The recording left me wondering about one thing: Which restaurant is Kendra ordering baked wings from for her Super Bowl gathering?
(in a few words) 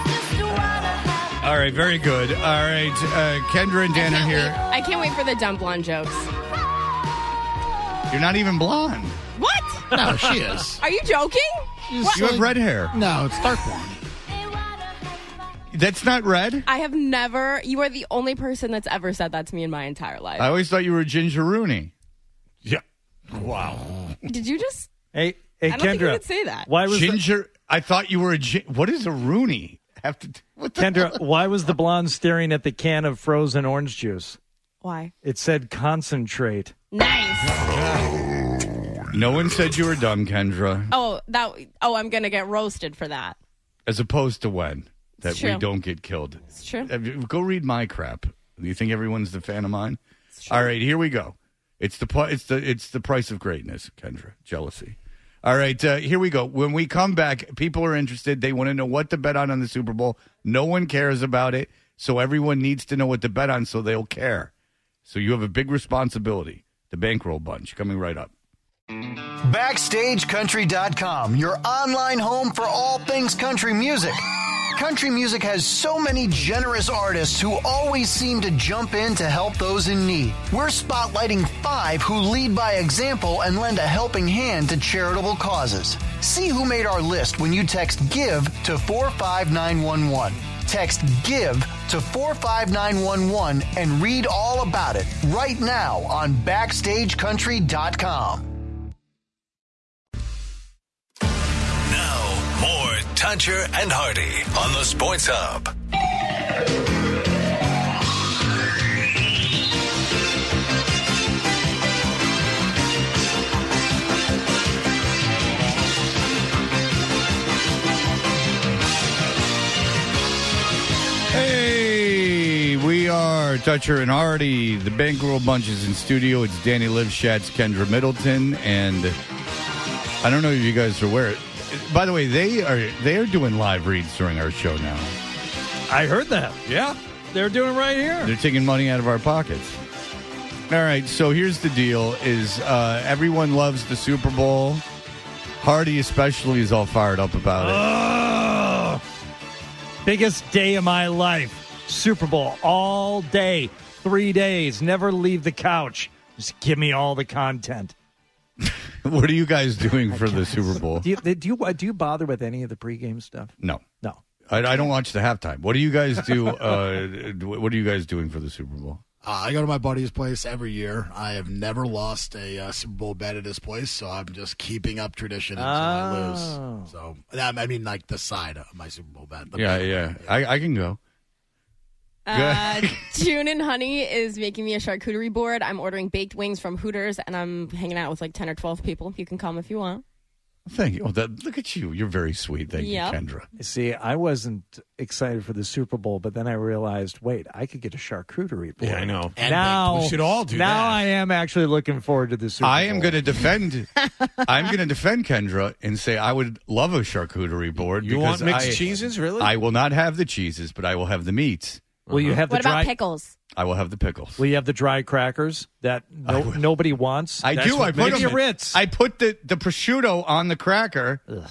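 Hooters.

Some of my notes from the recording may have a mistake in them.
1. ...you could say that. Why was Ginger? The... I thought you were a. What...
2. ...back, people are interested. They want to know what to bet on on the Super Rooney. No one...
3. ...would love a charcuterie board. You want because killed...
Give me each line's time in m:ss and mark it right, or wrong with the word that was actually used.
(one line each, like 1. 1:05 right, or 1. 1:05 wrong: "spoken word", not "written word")
1. 0:26 right
2. 0:57 wrong: "Bowl", not "Rooney"
3. 3:26 wrong: "mixed", not "killed".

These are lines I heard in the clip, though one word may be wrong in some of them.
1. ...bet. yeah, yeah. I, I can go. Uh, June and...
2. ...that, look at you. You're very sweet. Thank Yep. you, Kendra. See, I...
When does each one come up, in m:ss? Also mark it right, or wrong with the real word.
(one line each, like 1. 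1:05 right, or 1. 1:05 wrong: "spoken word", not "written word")
1. 2:59 right
2. 3:11 right.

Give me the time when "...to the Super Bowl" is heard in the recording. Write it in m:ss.
3:22.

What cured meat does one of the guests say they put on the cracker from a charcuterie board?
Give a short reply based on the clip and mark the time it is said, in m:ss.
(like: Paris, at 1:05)
Prosciutto, at 3:39.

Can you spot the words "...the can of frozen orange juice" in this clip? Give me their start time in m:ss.
0:32.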